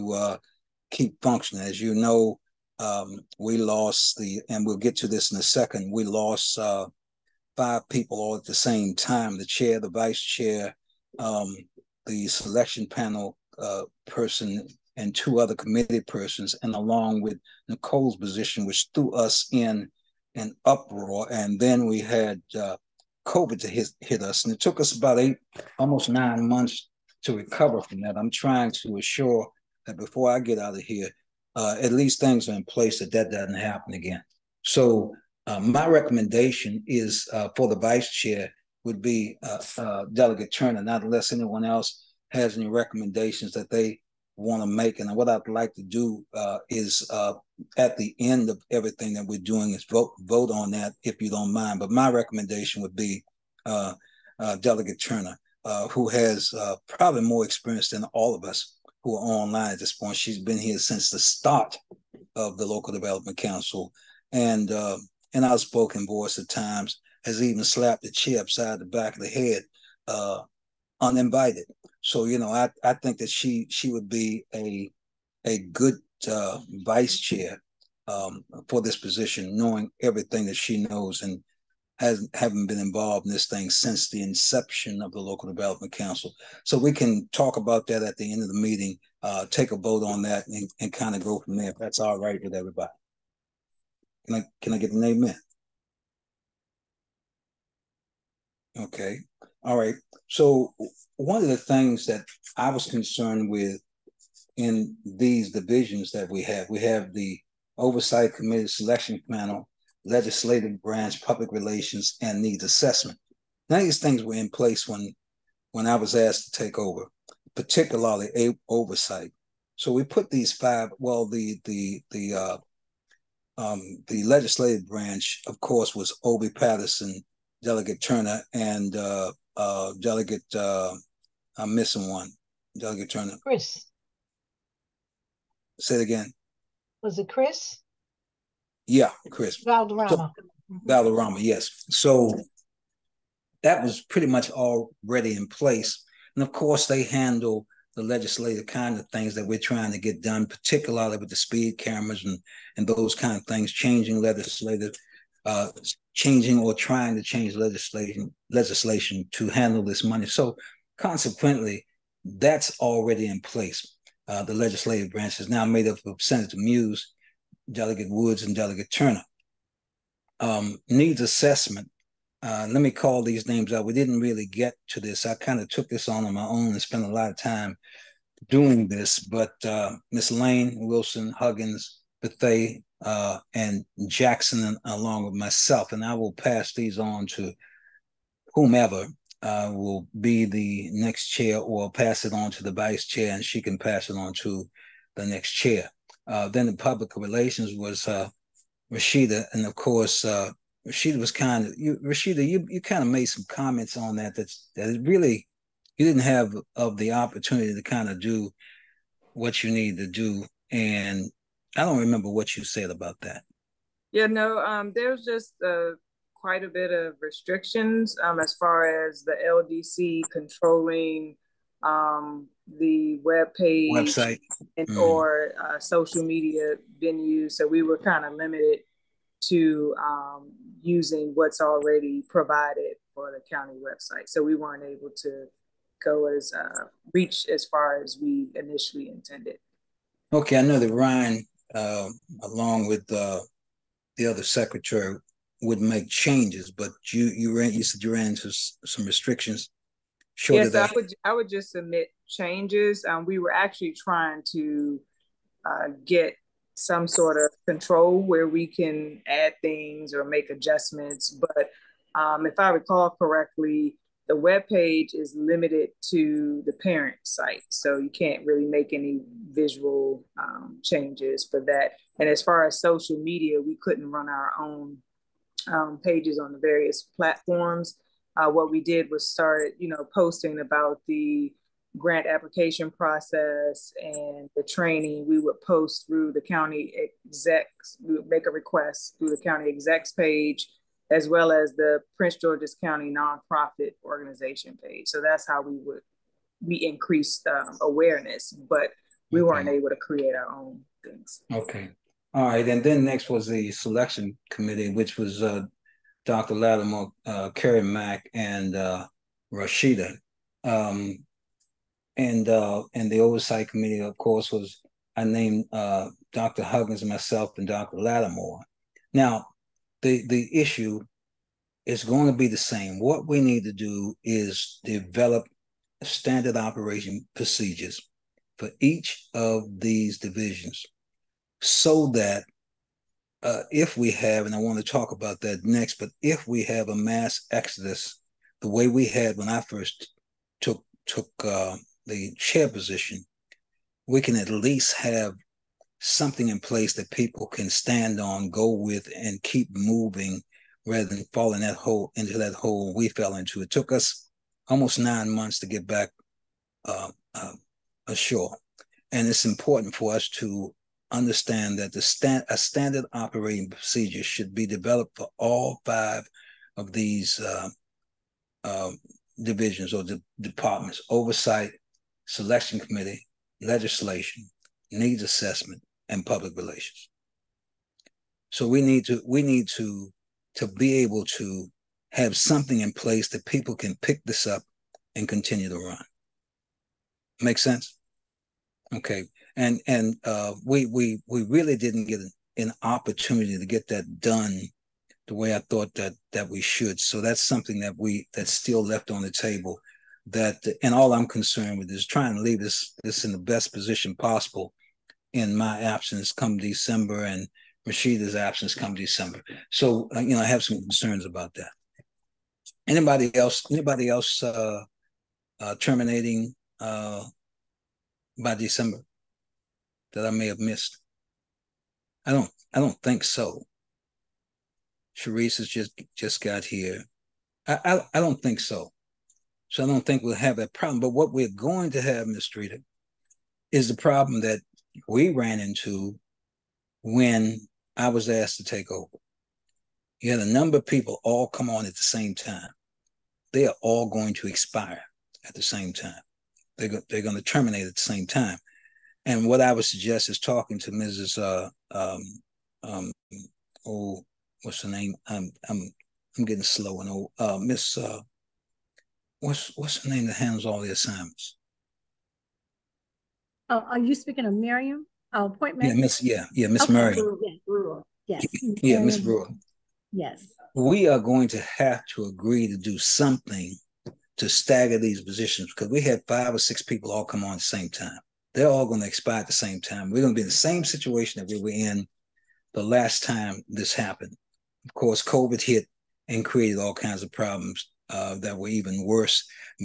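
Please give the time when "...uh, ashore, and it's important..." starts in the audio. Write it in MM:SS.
05:57.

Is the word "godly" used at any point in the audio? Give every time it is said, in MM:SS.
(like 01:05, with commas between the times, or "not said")
not said.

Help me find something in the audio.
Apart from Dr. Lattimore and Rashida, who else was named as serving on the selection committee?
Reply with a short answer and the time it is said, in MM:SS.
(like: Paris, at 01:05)
Kerry Mack, at 05:07.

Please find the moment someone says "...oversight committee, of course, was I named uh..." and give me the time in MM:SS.
05:13.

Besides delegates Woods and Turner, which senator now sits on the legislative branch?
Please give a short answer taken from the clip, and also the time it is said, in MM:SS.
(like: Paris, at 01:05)
Senator Muse, at 02:46.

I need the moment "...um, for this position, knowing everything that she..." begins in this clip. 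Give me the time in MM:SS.
01:18.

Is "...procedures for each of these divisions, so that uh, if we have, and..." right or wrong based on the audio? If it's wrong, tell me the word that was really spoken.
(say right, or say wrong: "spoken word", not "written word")
right.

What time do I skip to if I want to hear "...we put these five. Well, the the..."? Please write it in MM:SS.
01:59.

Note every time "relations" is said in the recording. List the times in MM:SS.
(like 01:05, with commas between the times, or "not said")
01:51, 03:17, 06:16.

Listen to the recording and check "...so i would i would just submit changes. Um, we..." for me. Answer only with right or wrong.
right.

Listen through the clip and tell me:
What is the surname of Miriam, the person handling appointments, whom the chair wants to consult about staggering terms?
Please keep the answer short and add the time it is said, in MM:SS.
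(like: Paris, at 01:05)
Brewer, at 07:49.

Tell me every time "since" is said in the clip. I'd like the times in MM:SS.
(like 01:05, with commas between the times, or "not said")
01:00, 01:23.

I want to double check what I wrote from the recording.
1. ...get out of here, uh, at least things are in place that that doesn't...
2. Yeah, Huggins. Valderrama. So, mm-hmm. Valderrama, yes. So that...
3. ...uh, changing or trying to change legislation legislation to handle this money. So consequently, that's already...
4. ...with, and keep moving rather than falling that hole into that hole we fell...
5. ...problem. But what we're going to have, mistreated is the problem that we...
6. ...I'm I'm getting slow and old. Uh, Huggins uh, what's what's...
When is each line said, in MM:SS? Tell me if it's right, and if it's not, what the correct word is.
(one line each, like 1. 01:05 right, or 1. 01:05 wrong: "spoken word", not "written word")
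1. 00:30 right
2. 02:18 wrong: "Chris", not "Huggins"
3. 02:35 right
4. 05:48 right
5. 07:10 right
6. 07:35 wrong: "Miss", not "Huggins".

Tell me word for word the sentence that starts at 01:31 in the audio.
If that's all right with everybody.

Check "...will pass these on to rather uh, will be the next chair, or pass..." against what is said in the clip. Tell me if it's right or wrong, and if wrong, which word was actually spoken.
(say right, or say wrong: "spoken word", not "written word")
wrong: "whomever", not "rather".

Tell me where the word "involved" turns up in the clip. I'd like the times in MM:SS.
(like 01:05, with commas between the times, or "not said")
01:22.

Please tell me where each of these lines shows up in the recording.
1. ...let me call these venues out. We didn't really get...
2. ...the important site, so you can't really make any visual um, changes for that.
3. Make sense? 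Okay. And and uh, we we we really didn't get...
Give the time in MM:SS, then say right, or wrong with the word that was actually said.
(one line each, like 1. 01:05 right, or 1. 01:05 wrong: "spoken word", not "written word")
1. 02:52 wrong: "names", not "venues"
2. 04:26 wrong: "parent", not "important"
3. 06:27 right.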